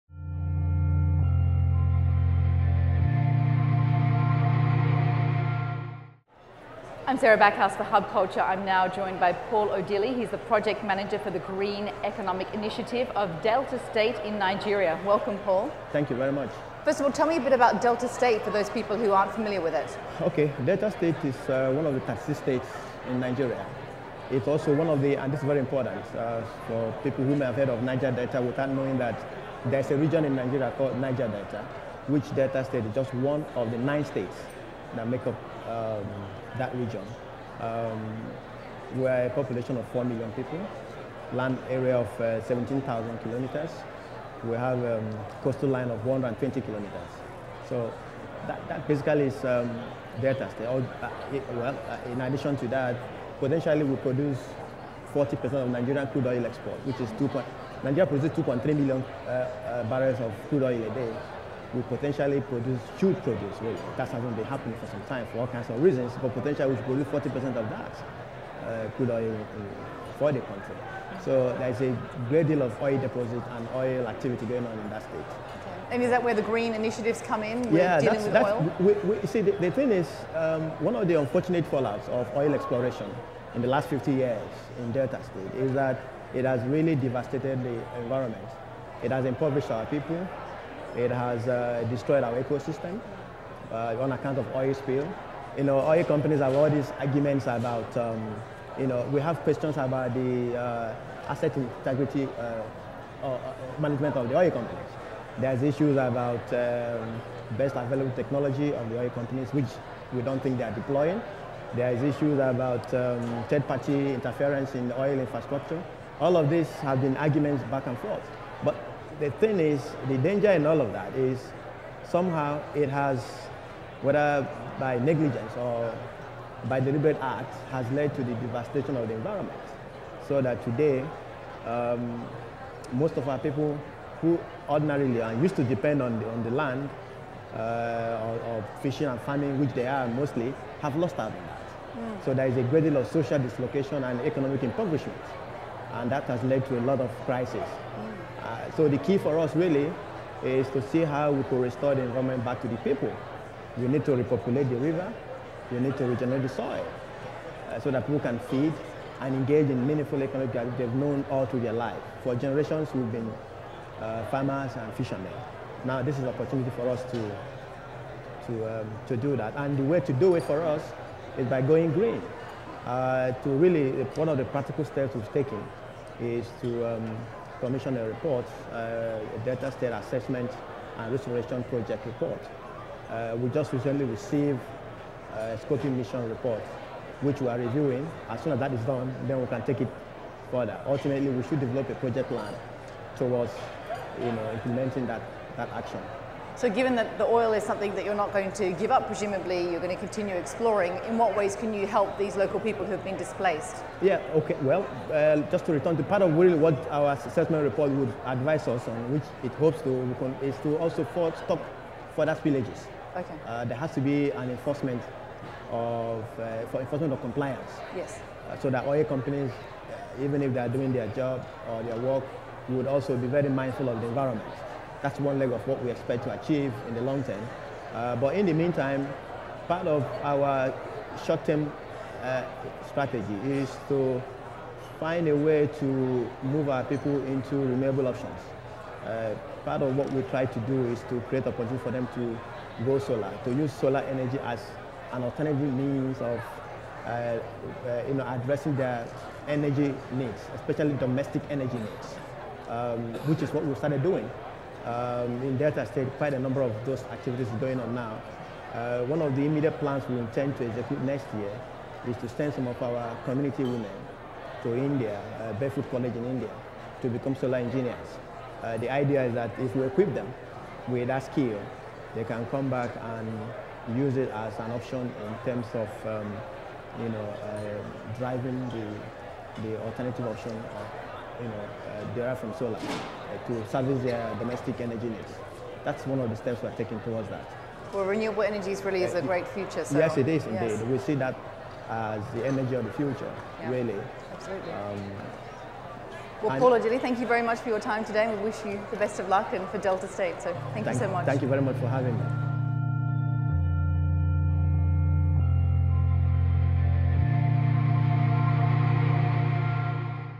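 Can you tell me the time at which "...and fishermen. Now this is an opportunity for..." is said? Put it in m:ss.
2:44.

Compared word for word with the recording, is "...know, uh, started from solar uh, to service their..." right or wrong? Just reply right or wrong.
wrong.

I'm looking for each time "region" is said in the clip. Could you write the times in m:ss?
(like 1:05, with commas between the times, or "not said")
0:29, 0:36.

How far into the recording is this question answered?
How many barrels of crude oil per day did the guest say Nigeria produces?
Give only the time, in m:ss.
0:58.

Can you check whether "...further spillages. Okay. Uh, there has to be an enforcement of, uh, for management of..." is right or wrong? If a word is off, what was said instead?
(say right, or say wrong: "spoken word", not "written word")
wrong: "enforcement", not "management".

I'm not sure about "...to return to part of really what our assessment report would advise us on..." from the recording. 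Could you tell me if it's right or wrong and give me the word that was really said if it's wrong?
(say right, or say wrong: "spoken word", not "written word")
right.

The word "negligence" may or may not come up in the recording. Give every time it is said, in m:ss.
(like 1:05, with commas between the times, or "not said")
2:04.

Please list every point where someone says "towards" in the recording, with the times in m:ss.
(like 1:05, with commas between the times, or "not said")
3:13, 4:47.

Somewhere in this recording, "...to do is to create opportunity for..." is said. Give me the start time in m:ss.
4:00.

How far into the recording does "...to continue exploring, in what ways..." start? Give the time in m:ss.
3:19.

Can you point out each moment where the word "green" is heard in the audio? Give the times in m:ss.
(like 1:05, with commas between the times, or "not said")
0:11, 1:16, 2:51.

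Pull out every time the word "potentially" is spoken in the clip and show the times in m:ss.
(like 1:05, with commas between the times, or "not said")
0:53, 1:01, 1:06.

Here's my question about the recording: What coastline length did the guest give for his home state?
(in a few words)
120 kilometers.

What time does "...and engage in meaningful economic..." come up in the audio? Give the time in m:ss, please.
2:39.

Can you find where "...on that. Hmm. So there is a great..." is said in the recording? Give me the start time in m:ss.
2:21.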